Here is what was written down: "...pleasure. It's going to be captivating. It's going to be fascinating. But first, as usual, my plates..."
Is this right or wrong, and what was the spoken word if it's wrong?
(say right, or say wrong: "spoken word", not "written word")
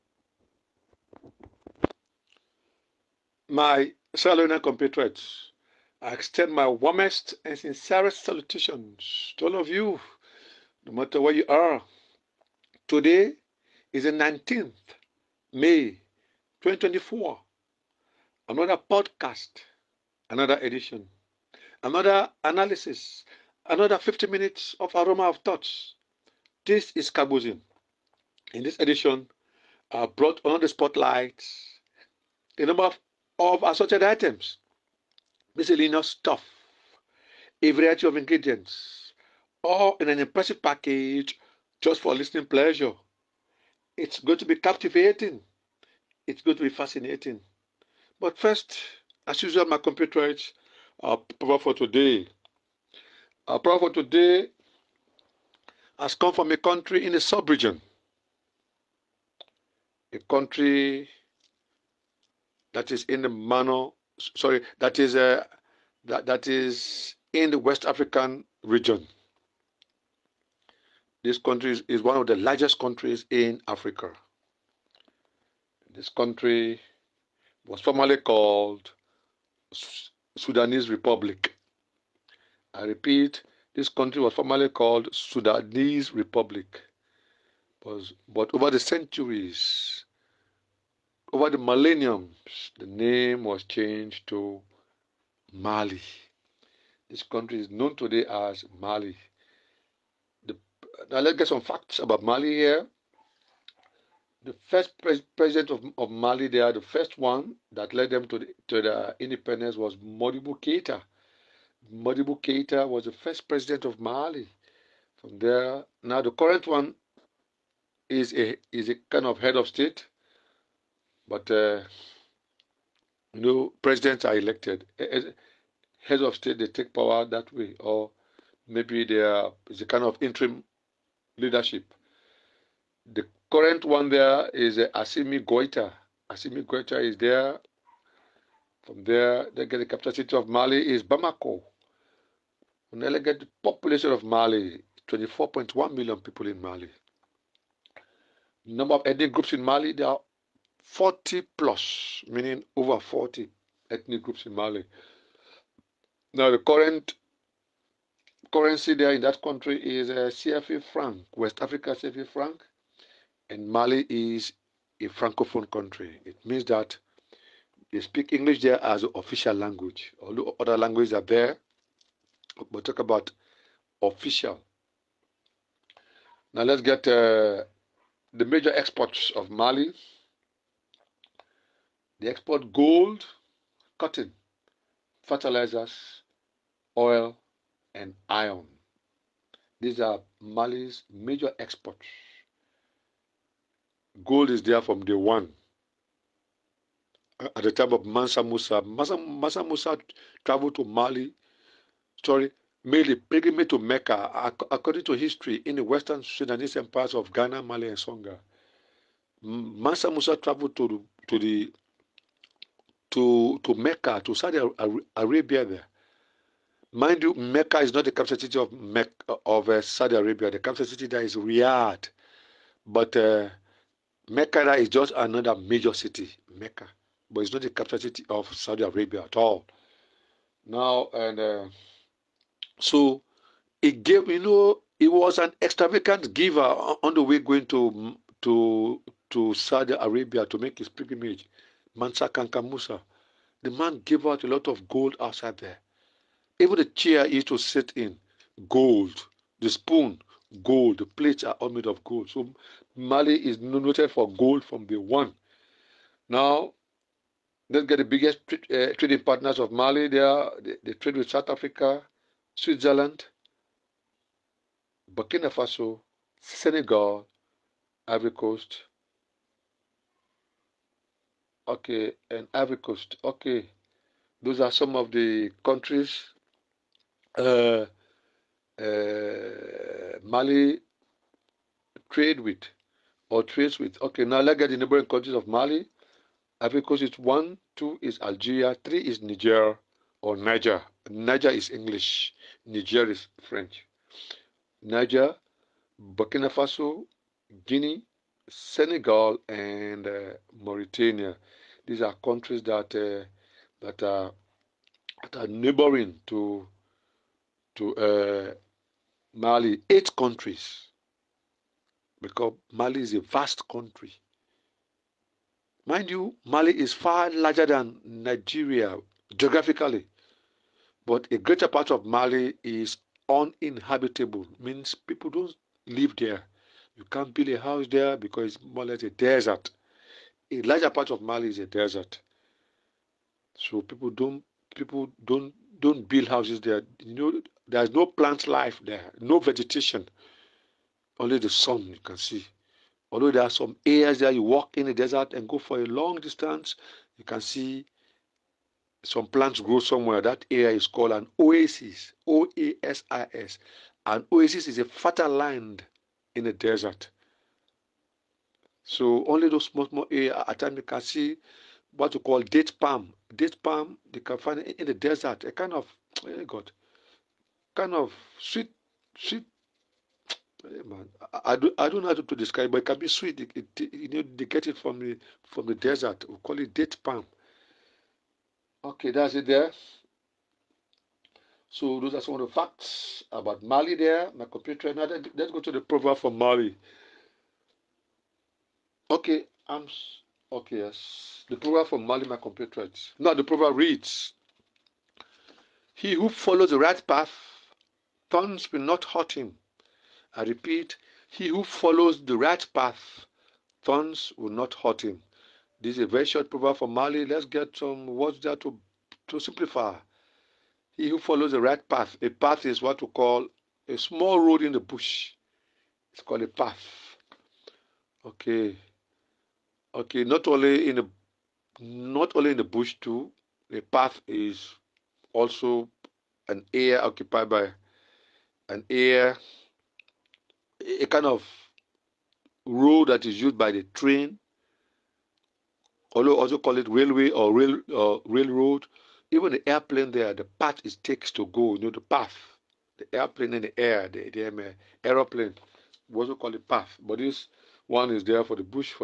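wrong: "computerites", not "plates".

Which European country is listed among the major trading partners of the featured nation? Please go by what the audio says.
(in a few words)
Switzerland.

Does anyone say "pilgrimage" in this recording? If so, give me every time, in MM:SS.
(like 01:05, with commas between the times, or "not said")
03:23, 04:00.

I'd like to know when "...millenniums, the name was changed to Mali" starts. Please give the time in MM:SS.
01:31.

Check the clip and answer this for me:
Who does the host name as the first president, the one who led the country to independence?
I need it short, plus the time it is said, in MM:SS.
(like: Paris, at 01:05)
Modibo Keita, at 01:51.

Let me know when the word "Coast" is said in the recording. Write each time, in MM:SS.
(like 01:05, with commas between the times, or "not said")
04:28, 04:32, 04:46.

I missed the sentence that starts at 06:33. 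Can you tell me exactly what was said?
Now the proverb reads: He who follows the right path, thorns will not hurt him.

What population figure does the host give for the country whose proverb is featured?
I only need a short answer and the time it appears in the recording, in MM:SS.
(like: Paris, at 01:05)
24.1 million, at 02:25.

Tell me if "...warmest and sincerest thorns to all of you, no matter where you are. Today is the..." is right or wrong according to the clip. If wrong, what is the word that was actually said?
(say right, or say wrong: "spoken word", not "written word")
wrong: "salutations", not "thorns".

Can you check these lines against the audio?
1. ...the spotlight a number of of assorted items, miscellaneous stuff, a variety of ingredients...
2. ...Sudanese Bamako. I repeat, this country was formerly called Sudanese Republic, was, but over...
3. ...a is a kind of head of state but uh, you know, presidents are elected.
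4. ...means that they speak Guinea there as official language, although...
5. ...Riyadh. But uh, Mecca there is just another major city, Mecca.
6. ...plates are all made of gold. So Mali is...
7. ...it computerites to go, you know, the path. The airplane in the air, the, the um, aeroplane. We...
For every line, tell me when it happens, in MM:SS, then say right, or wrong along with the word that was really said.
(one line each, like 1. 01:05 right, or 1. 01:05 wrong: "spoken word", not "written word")
1. 00:30 right
2. 01:20 wrong: "Republic", not "Bamako"
3. 01:58 right
4. 02:46 wrong: "English", not "Guinea"
5. 03:41 right
6. 04:11 right
7. 07:20 wrong: "takes", not "computerites".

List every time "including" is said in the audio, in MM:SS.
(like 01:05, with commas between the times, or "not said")
not said.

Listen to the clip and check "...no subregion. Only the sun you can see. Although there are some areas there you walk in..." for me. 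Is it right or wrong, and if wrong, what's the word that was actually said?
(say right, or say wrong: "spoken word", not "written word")
wrong: "vegetation", not "subregion".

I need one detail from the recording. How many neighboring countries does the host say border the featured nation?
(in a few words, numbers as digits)
8.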